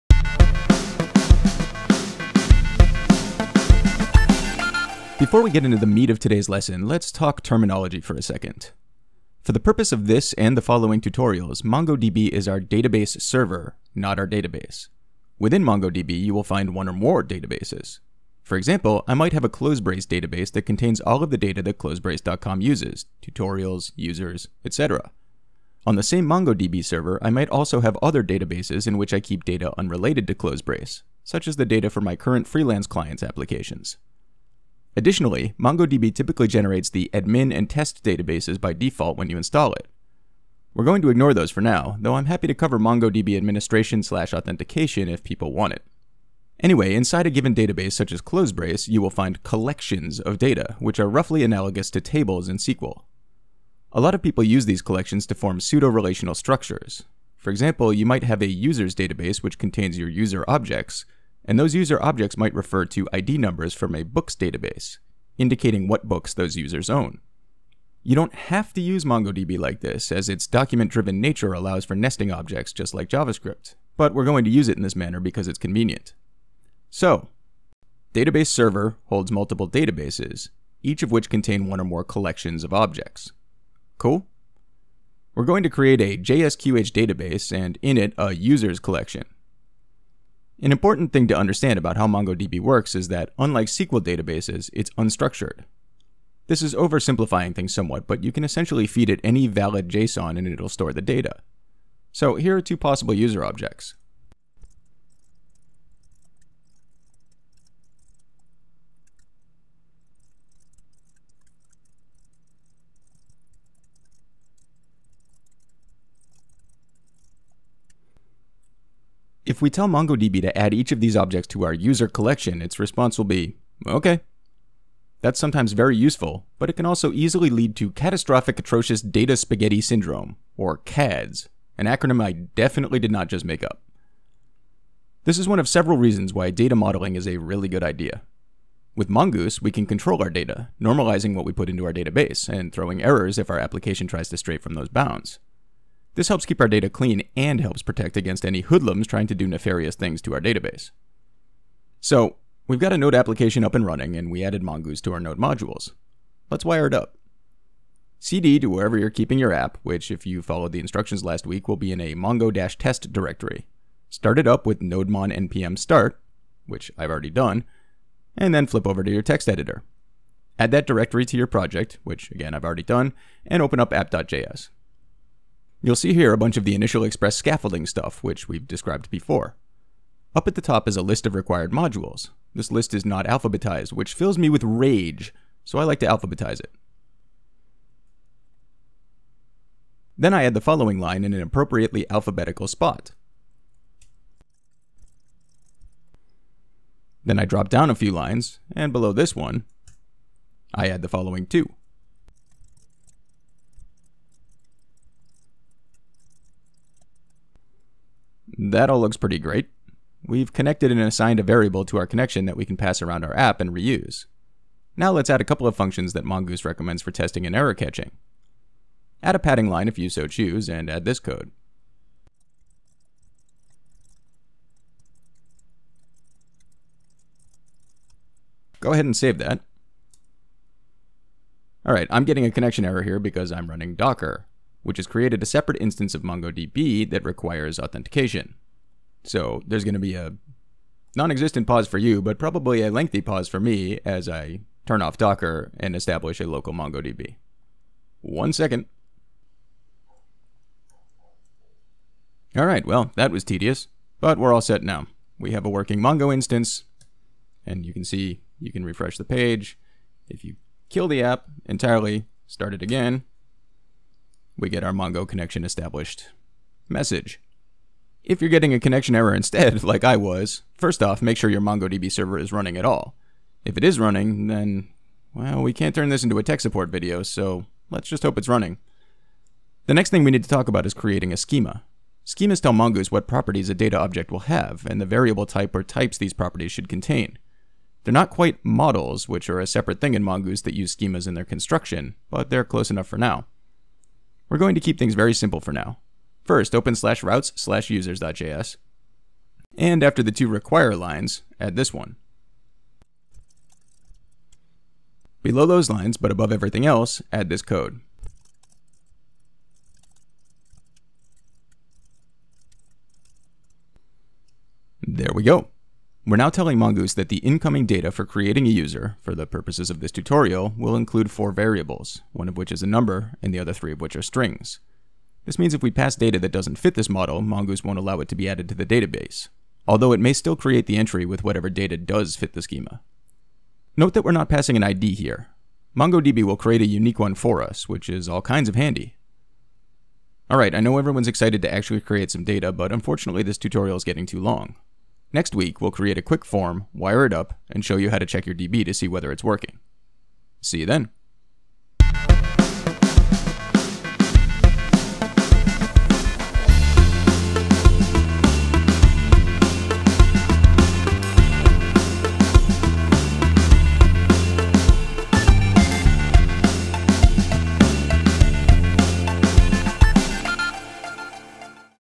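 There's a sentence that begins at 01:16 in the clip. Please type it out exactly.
So, database server holds multiple databases, each of which contain one or more collections of objects.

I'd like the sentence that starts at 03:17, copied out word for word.
Then I drop down a few lines, and below this one, I add the following two.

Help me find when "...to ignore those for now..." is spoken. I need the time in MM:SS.
00:41.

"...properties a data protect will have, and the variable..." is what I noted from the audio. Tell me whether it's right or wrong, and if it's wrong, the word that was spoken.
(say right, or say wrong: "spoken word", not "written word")
wrong: "object", not "protect".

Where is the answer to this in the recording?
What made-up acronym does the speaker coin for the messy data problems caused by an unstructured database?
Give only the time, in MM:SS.
02:10.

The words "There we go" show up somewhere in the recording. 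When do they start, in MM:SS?
05:15.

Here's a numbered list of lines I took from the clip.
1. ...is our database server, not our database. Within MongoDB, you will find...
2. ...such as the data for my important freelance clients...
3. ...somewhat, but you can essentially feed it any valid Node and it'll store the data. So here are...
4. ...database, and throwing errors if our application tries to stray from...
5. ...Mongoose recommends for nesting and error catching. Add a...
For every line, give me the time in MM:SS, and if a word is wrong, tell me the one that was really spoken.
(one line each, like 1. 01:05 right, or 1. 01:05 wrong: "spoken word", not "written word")
1. 00:12 right
2. 00:31 wrong: "current", not "important"
3. 01:37 wrong: "JSON", not "Node"
4. 02:21 right
5. 03:36 wrong: "testing", not "nesting".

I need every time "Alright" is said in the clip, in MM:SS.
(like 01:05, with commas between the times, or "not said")
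03:51, 05:40.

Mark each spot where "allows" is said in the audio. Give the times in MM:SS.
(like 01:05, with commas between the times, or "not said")
01:11, 05:27.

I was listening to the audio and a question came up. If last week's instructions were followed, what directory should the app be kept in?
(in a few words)
mongo-test.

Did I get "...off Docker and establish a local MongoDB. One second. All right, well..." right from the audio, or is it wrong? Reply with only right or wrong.
right.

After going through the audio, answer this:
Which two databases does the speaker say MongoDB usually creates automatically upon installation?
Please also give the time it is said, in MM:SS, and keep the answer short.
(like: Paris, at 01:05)
admin and test, at 00:37.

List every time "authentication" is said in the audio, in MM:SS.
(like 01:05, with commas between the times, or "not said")
00:44, 03:57.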